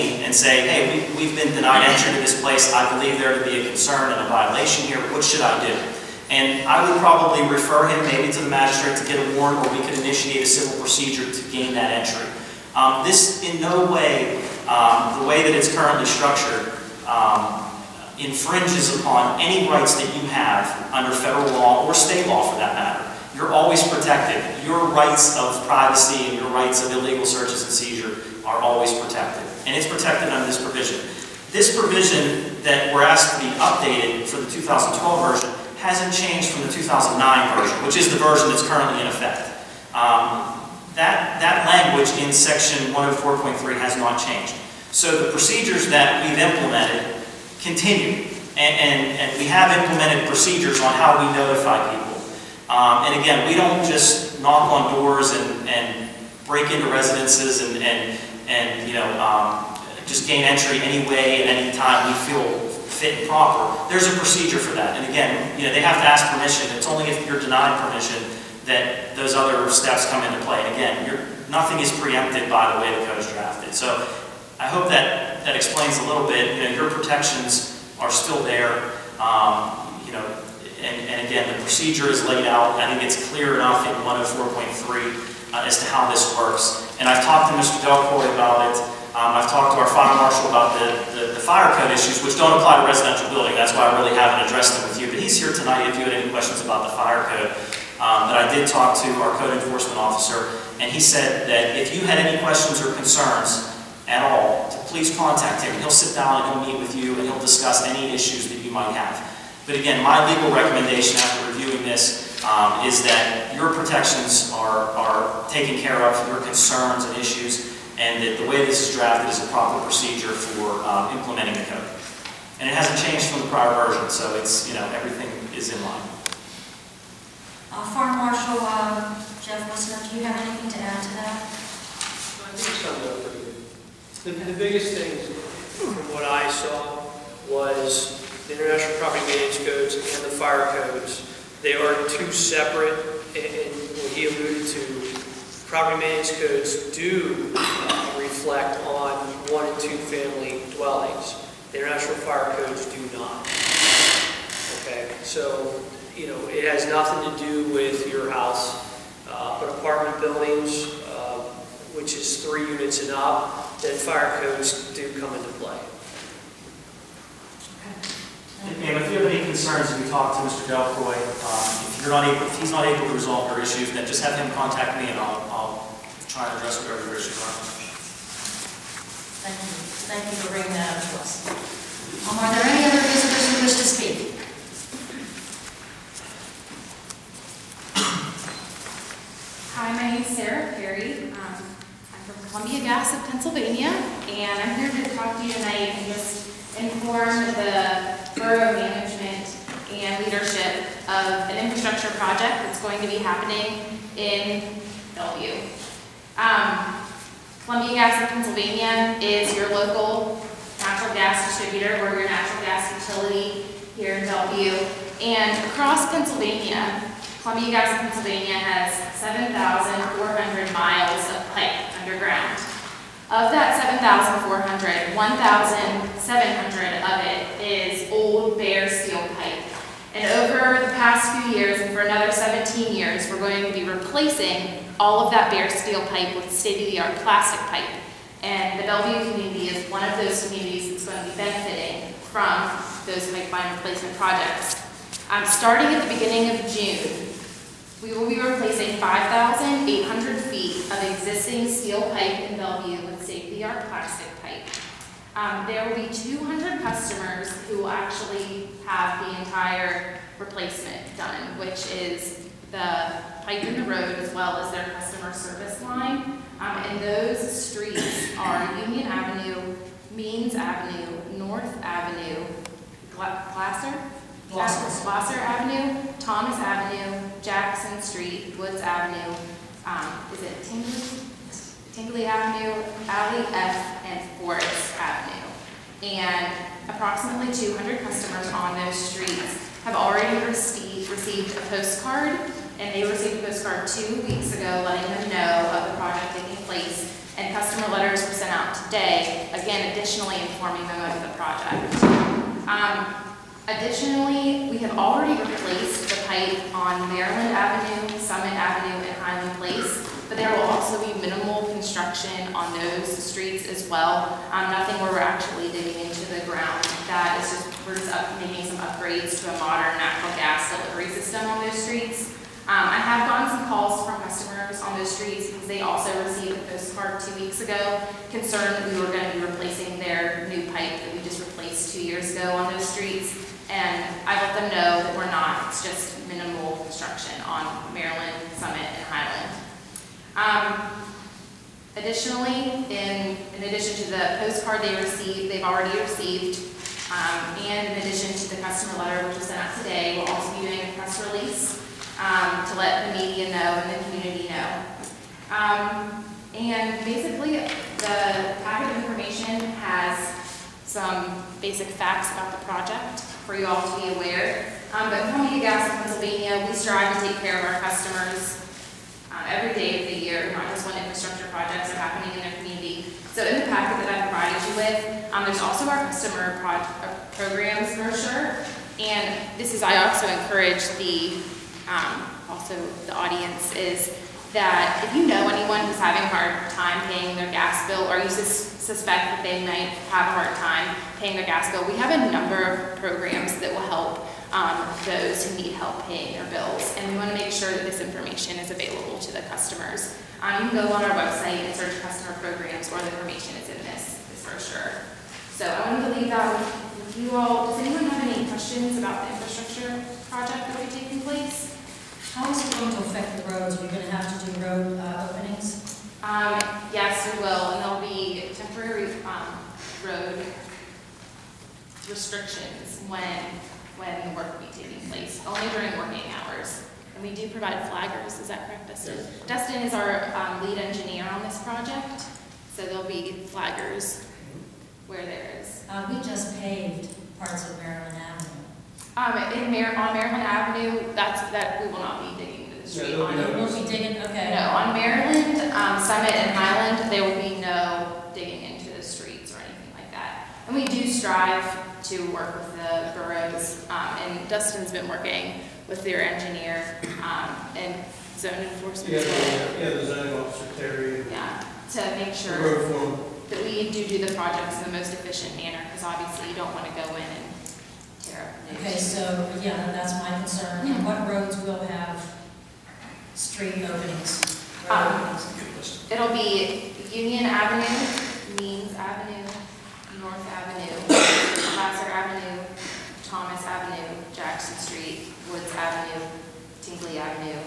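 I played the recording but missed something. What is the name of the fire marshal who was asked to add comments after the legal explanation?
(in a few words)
Jeff Wissner.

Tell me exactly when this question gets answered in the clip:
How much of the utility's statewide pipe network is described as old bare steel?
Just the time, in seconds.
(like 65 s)
225 s.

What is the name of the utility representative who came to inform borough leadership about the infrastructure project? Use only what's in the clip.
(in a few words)
Sarah Perry.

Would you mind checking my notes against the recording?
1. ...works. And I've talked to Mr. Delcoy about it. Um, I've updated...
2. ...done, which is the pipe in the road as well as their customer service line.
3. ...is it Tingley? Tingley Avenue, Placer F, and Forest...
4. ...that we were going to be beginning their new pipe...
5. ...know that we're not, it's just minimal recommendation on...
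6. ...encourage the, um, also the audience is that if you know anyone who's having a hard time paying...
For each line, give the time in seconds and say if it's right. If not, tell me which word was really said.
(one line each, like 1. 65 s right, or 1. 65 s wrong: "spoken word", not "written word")
1. 86 s wrong: "talked", not "updated"
2. 261 s right
3. 280 s wrong: "Alley", not "Placer"
4. 328 s wrong: "replacing", not "beginning"
5. 334 s wrong: "construction", not "recommendation"
6. 380 s right.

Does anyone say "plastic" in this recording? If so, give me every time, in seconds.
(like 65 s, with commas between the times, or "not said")
237 s, 253 s.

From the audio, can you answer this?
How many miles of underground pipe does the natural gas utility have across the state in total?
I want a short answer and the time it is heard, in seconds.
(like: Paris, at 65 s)
7,400, at 219 s.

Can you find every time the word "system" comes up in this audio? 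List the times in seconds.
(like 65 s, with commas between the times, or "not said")
321 s.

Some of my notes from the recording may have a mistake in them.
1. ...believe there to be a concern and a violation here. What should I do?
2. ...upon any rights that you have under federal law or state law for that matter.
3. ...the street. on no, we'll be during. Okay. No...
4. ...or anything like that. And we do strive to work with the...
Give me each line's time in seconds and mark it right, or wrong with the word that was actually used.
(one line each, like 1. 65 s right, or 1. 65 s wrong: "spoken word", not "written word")
1. 2 s right
2. 18 s right
3. 442 s wrong: "digging", not "during"
4. 449 s right.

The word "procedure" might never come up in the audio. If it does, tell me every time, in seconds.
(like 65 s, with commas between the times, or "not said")
10 s, 45 s, 50 s, 64 s, 81 s, 119 s.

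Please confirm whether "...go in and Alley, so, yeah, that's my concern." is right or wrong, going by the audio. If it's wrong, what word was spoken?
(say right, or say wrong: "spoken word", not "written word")
wrong: "Okay", not "Alley".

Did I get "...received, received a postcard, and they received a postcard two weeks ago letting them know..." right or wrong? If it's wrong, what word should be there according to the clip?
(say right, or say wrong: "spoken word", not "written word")
right.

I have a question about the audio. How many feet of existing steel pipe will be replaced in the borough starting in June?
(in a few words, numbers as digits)
5,800 feet.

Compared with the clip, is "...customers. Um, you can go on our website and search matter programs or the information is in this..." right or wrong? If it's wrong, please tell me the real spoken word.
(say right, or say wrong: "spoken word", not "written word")
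wrong: "customer", not "matter".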